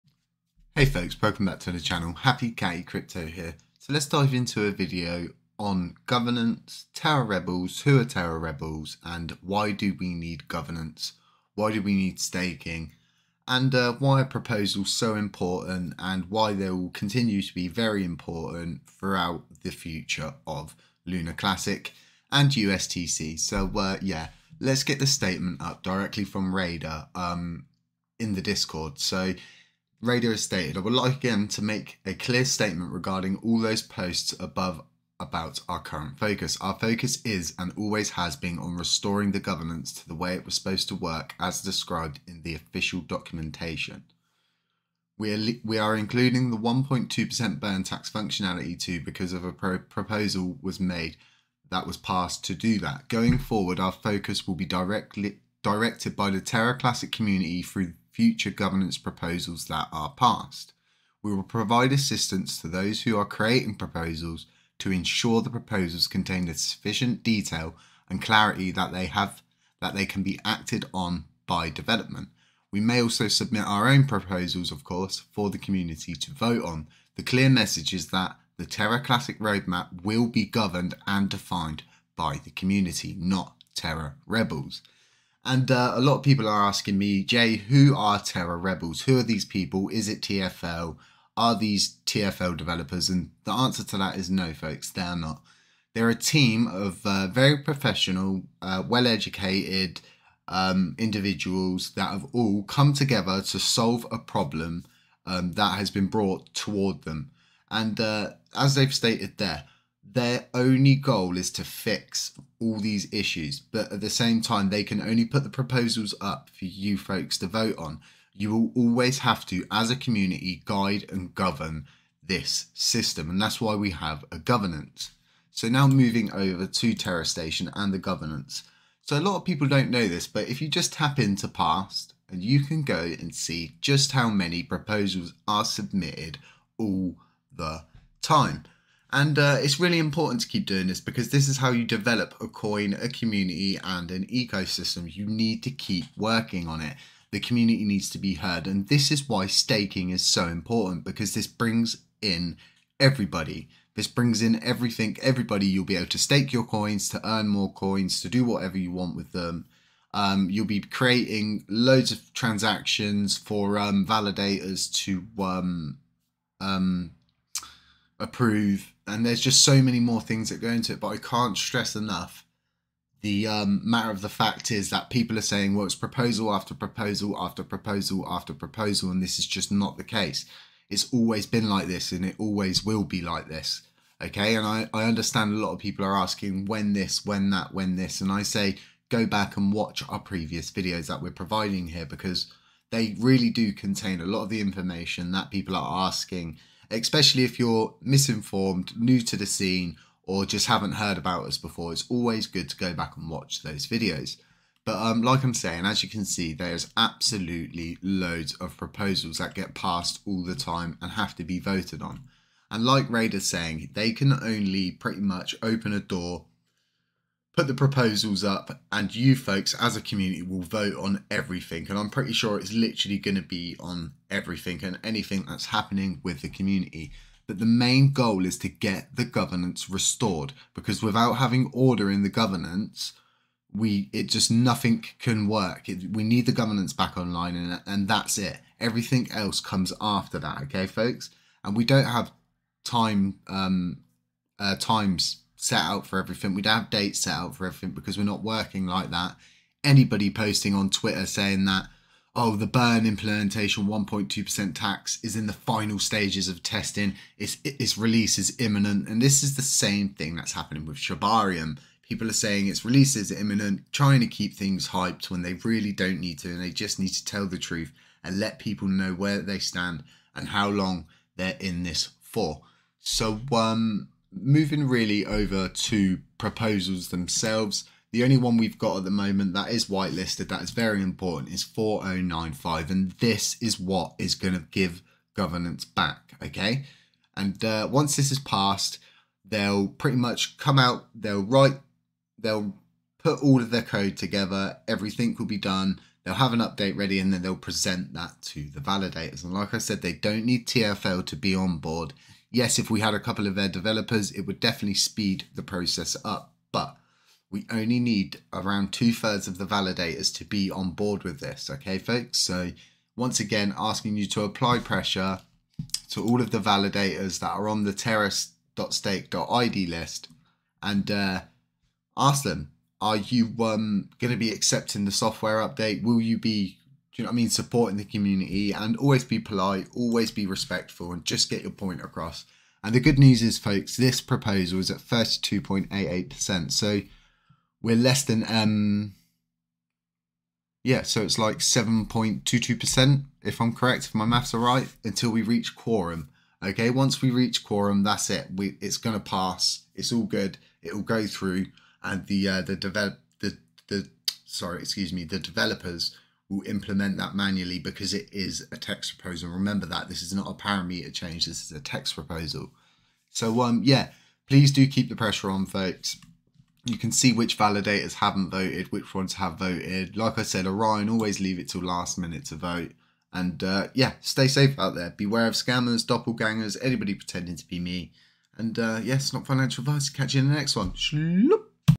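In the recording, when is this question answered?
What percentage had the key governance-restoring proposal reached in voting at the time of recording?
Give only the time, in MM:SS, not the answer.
05:34.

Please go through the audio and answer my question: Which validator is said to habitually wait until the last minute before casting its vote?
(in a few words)
Orion.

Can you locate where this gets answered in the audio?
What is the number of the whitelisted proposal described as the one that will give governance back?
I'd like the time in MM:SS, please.
04:41.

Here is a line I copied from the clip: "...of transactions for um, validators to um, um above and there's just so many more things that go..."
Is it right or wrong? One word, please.
wrong.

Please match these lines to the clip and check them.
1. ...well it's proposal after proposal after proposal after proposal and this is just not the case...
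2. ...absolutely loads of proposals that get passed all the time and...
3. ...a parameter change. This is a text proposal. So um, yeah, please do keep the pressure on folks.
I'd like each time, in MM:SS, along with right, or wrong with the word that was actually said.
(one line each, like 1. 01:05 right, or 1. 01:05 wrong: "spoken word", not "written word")
1. 02:55 right
2. 03:26 right
3. 06:00 right.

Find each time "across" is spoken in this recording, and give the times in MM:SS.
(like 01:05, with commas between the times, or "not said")
05:32.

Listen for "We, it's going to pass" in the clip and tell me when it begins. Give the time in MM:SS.
05:48.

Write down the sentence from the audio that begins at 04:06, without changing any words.
We would have dates set out for everything because we're not working like that.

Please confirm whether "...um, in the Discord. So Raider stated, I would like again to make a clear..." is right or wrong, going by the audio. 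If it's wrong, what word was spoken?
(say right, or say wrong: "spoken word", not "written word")
right.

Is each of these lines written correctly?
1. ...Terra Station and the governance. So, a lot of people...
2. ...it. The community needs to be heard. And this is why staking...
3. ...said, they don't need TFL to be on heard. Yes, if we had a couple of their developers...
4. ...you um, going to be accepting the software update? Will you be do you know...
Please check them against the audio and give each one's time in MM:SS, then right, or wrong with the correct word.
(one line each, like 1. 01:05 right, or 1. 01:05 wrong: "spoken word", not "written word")
1. 02:06 right
2. 02:26 right
3. 04:59 wrong: "board", not "heard"
4. 05:23 right.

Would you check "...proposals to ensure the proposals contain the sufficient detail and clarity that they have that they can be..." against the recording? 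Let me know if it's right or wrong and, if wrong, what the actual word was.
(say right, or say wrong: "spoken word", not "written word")
right.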